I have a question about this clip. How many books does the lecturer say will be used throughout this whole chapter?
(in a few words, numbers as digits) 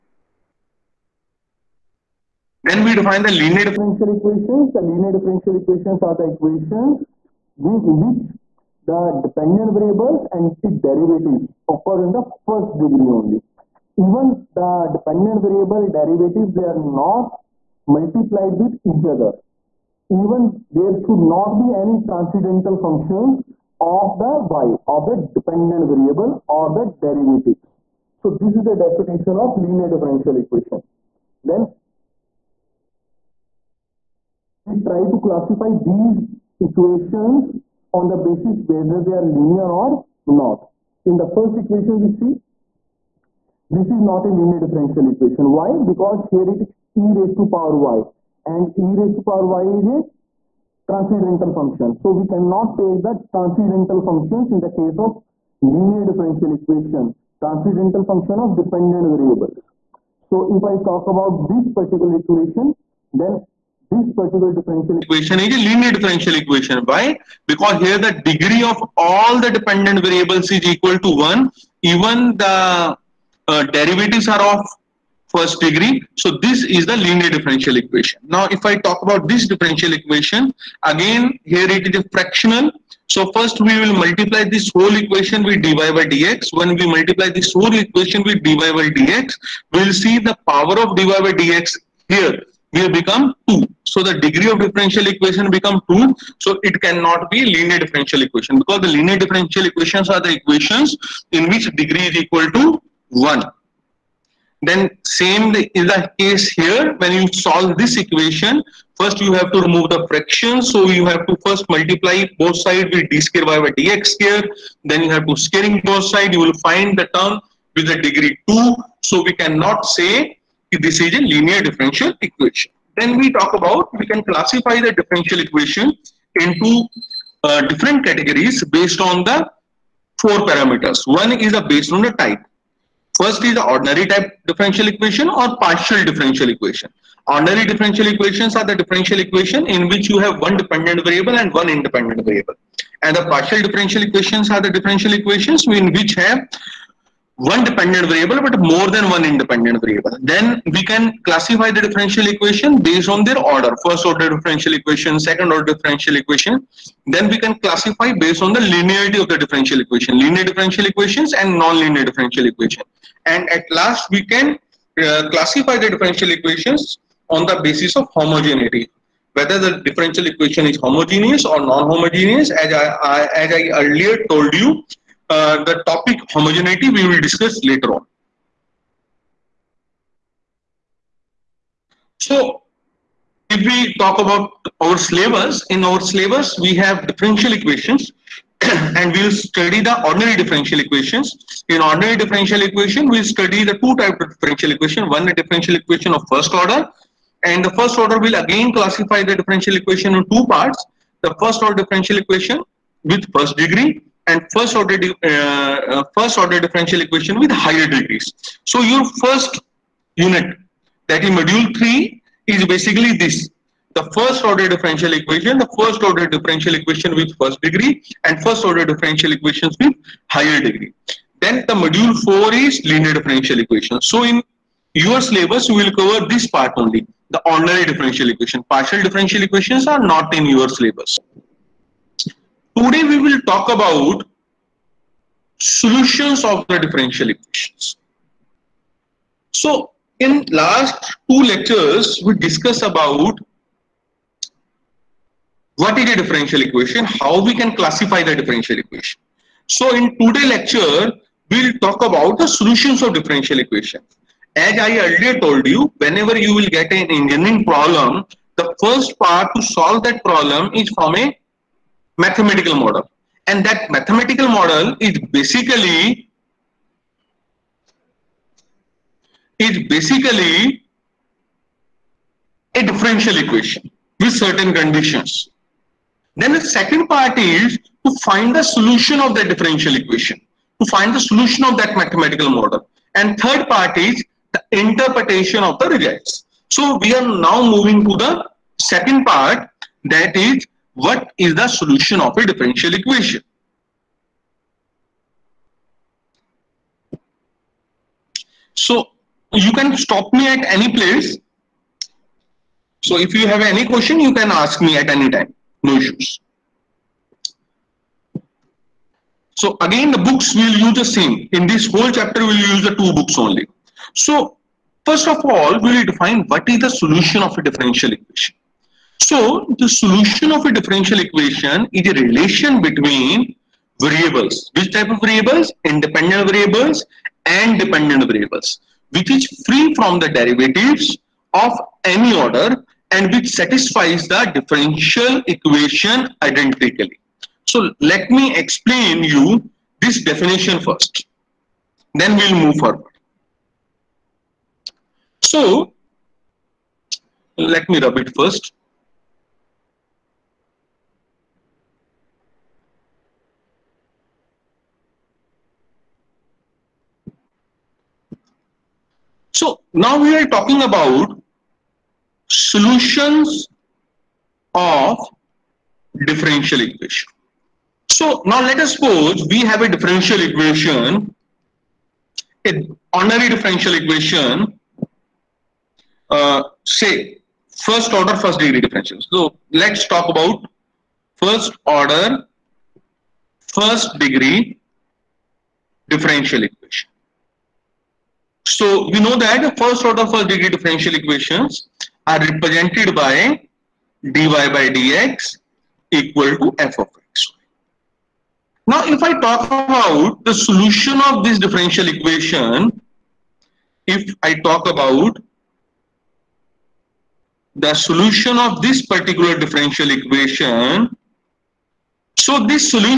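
2.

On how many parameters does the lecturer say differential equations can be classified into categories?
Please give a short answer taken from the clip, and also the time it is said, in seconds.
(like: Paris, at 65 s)
4, at 130 s.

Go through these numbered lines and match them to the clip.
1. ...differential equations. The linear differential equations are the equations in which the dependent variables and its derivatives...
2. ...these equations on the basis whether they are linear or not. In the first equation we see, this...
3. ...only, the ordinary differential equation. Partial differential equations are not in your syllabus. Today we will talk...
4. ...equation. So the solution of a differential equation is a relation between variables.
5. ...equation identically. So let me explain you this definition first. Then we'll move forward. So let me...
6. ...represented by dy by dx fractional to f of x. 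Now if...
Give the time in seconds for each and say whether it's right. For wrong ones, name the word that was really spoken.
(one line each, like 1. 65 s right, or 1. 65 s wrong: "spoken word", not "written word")
1. 3 s right
2. 35 s right
3. 226 s right
4. 318 s right
5. 335 s right
6. 392 s wrong: "equal", not "fractional".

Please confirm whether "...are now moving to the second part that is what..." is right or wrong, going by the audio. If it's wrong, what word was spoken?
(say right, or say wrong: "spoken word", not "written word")
right.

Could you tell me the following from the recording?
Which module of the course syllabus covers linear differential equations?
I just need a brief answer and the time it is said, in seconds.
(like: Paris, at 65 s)
Module 4, at 221 s.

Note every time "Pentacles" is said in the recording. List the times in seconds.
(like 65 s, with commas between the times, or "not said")
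not said.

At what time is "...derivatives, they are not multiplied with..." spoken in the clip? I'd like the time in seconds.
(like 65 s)
15 s.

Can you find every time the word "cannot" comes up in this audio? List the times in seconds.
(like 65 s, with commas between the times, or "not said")
52 s, 96 s, 119 s.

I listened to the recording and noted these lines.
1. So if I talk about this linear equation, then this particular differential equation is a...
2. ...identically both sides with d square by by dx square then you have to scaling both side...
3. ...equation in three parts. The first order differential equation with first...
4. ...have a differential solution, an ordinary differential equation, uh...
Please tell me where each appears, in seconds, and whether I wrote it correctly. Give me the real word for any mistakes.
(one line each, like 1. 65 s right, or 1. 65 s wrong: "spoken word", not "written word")
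1. 60 s wrong: "particular", not "linear"
2. 111 s wrong: "multiply", not "identically"
3. 199 s wrong: "two", not "three"
4. 369 s wrong: "equation", not "solution".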